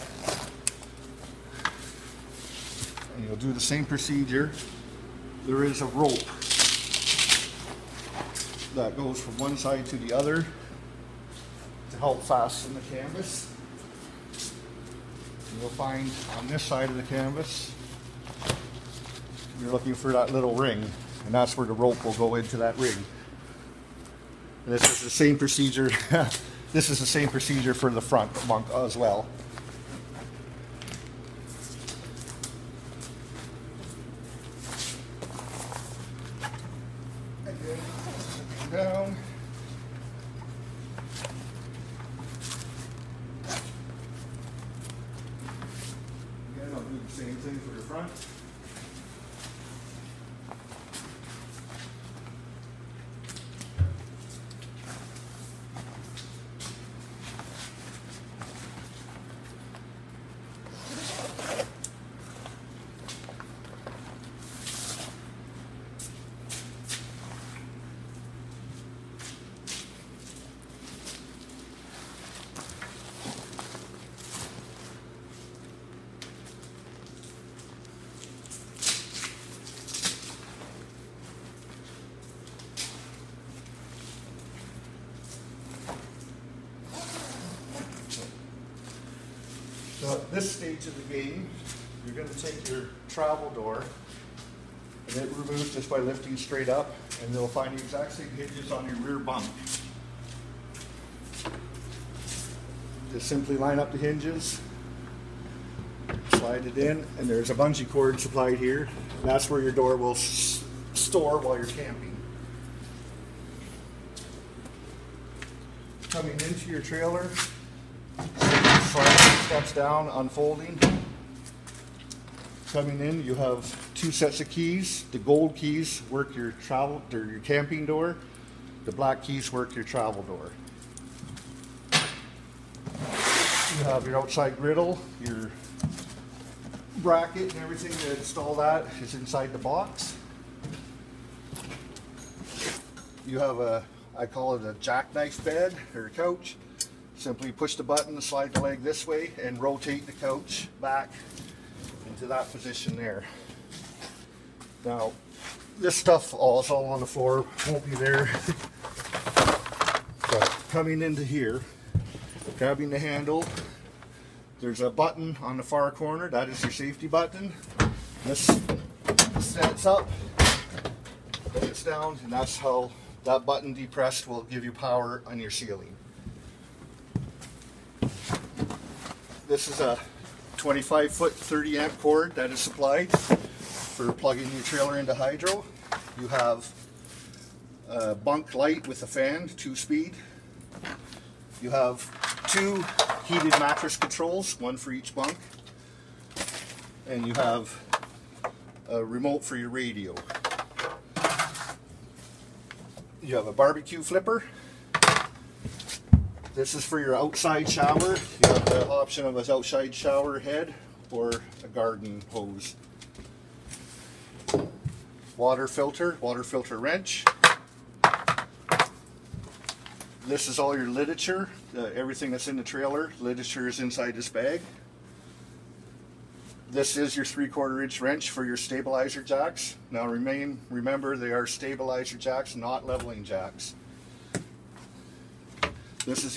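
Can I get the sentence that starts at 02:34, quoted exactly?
Now, this stuff all is all on the floor, won't be there.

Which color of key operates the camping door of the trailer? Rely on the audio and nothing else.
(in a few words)
Gold.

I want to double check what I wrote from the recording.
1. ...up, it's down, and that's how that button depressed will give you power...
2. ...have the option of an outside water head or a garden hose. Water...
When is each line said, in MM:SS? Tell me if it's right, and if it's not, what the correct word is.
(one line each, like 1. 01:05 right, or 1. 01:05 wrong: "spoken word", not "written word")
1. 02:49 right
2. 03:28 wrong: "shower", not "water".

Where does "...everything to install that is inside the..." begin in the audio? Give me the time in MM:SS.
02:17.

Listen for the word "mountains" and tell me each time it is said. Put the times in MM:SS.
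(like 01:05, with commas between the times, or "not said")
not said.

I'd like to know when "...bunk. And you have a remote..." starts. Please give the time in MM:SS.
03:15.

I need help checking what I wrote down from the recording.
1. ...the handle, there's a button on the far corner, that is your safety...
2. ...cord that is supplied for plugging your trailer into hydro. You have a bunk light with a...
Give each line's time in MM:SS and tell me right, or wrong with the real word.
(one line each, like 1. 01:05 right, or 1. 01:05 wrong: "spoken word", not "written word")
1. 02:42 right
2. 03:01 right.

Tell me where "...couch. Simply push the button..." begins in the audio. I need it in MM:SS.
02:26.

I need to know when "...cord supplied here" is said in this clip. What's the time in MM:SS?
01:47.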